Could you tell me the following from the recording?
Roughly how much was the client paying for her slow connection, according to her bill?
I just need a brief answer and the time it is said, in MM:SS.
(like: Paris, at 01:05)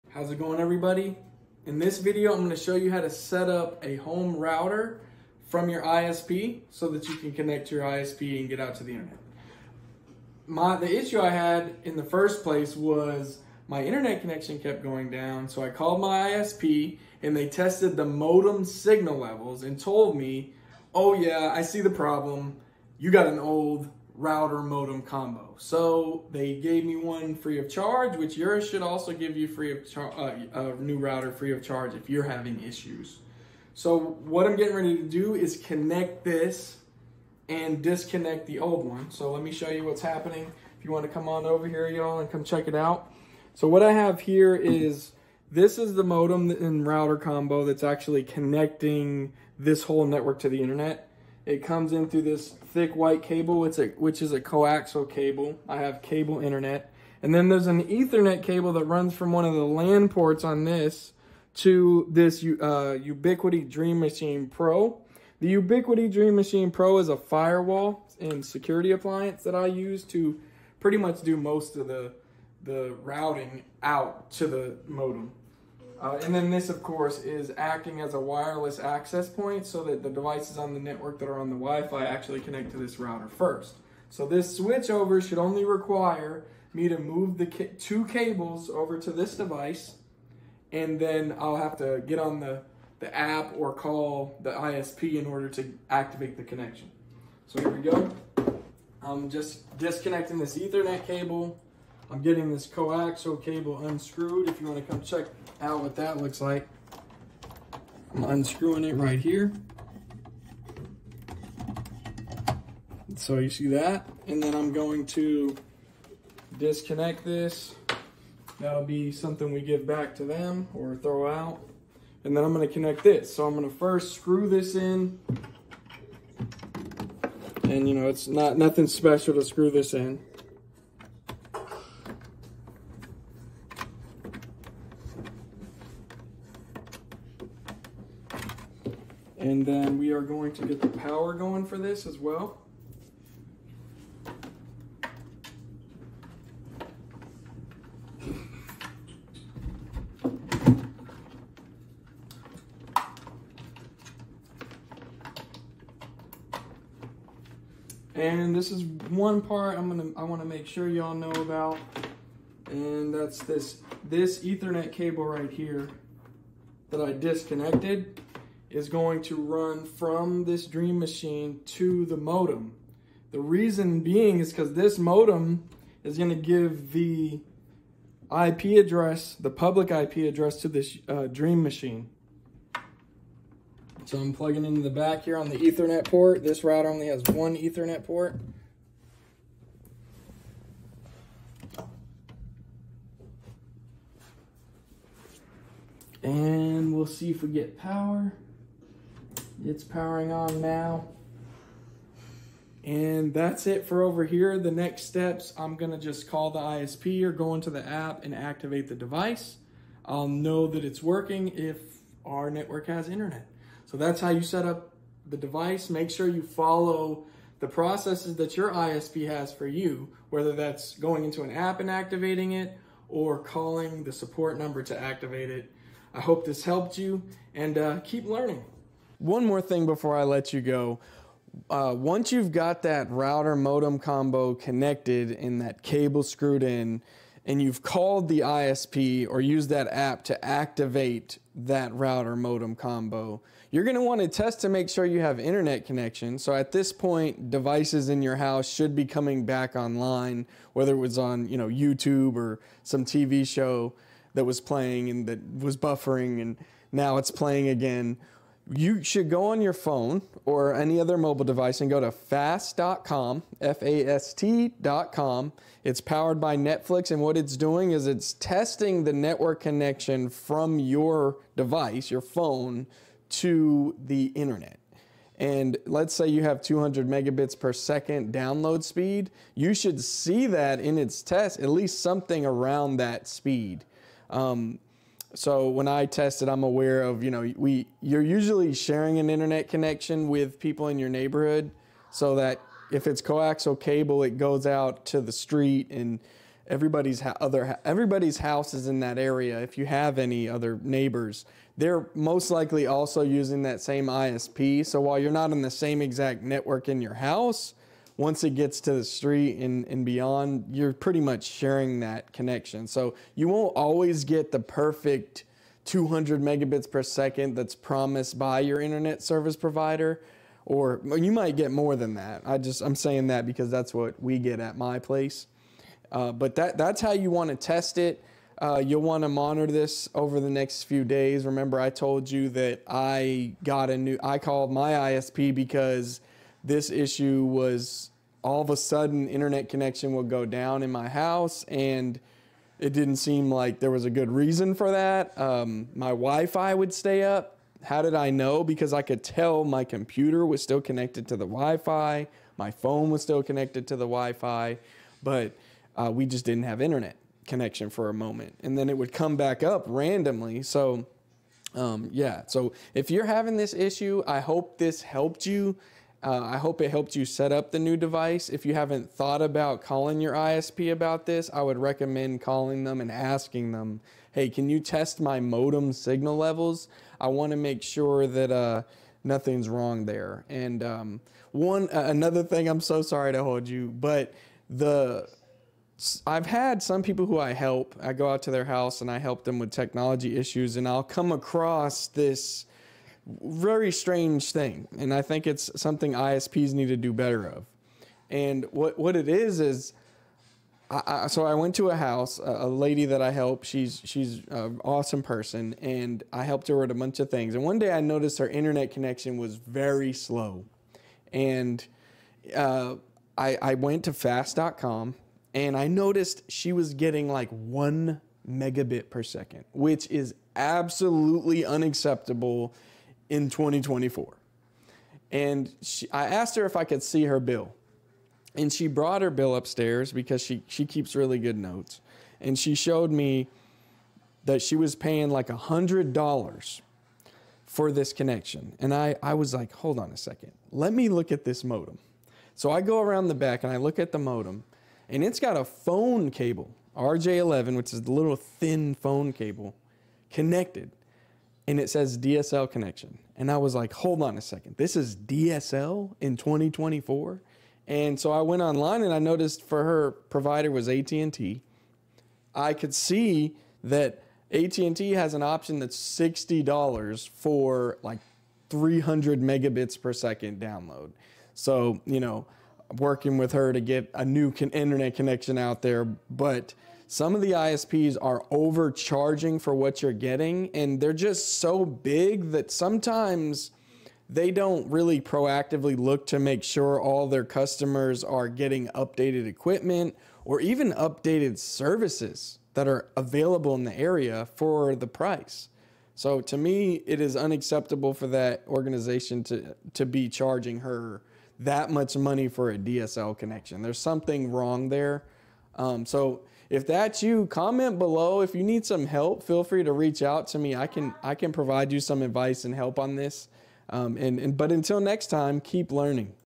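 $100, at 07:15.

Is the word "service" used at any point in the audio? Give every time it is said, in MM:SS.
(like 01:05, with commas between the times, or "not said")
05:19, 08:11.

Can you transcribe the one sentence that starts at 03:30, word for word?
I'll know that it's working if our network has internet.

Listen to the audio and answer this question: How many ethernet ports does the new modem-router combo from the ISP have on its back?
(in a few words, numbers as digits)
1.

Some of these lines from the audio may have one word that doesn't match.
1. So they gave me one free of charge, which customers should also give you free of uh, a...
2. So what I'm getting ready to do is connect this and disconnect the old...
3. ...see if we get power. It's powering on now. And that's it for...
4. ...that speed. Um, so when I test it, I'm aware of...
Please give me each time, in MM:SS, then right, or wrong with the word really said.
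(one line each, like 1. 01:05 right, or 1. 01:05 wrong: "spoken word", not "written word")
1. 00:25 wrong: "yours", not "customers"
2. 00:33 right
3. 03:17 right
4. 04:42 right.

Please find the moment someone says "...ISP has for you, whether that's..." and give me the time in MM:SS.
03:38.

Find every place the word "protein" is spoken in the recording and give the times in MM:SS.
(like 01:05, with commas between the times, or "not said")
not said.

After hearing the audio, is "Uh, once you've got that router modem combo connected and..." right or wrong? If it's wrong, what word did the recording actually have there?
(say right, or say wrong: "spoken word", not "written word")
right.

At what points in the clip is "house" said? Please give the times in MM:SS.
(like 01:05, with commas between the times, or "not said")
04:08, 04:58, 05:07, 05:41, 06:28, 06:41.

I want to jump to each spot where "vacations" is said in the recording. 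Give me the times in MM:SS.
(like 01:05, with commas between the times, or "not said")
not said.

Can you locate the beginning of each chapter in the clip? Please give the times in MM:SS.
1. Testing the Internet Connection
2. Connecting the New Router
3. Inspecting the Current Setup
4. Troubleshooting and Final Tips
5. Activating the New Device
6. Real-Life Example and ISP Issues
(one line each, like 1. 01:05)
1. 03:51
2. 01:38
3. 00:43
4. 05:31
5. 03:24
6. 06:20.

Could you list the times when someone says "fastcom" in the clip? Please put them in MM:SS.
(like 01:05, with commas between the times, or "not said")
04:22, 06:54.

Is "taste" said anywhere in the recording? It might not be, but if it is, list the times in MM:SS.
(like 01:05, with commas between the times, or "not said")
not said.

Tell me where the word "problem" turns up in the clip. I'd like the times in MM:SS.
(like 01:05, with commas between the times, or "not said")
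00:21.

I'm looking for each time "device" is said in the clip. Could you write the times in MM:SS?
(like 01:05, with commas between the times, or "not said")
01:20, 01:29, 03:28, 03:35, 04:07, 04:21, 04:31, 06:07.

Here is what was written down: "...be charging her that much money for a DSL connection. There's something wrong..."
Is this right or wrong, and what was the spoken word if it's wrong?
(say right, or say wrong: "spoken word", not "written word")
right.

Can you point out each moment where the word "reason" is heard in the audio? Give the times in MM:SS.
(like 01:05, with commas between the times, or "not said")
02:53, 05:44.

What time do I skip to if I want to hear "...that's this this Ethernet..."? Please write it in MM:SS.
02:43.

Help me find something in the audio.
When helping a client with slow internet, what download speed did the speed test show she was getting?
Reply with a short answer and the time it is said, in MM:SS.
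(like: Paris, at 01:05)
1 megabit per second, at 06:57.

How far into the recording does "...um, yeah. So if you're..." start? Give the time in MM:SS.
06:01.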